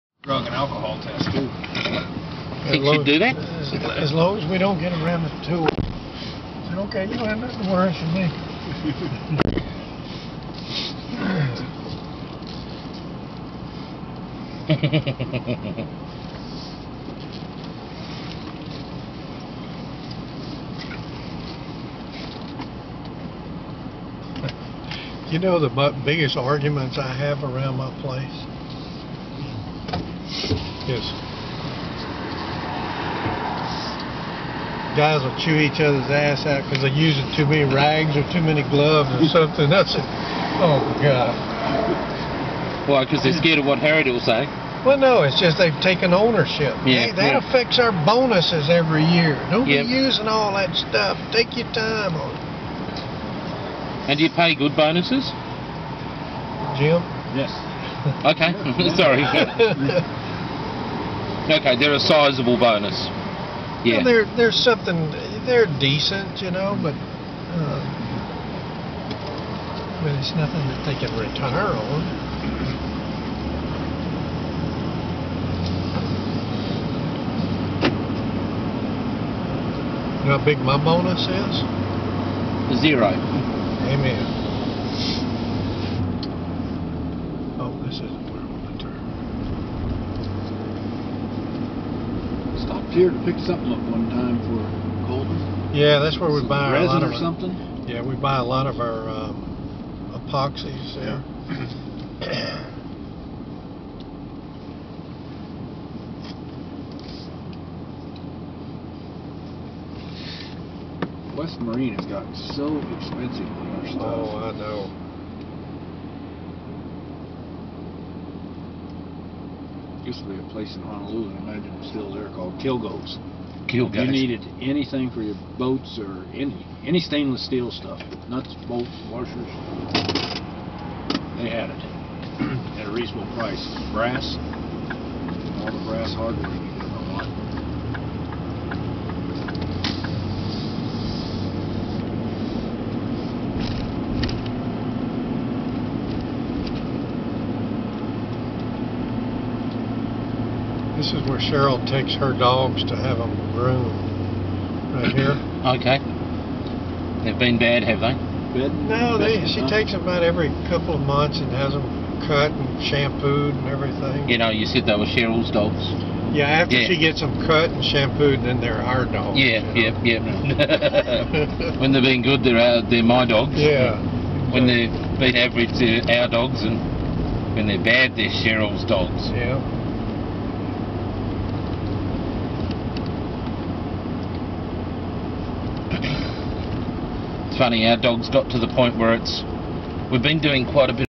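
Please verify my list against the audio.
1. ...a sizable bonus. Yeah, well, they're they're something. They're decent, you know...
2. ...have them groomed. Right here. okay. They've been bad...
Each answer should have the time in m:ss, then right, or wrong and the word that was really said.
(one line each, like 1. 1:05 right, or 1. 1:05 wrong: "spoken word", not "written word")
1. 1:01 right
2. 2:32 right.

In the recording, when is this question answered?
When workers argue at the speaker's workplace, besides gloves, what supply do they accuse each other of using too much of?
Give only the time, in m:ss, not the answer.
0:37.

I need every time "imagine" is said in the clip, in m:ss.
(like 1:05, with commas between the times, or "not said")
2:01.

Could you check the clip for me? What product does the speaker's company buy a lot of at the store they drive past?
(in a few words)
epoxies.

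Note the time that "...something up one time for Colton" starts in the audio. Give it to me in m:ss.
1:33.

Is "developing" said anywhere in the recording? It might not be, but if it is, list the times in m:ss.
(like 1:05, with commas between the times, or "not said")
not said.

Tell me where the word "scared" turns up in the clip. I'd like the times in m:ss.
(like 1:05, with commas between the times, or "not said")
0:43.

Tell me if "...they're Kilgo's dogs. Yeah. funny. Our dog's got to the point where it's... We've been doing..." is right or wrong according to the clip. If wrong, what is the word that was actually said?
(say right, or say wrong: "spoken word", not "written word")
wrong: "Cheryl", not "Kilgo".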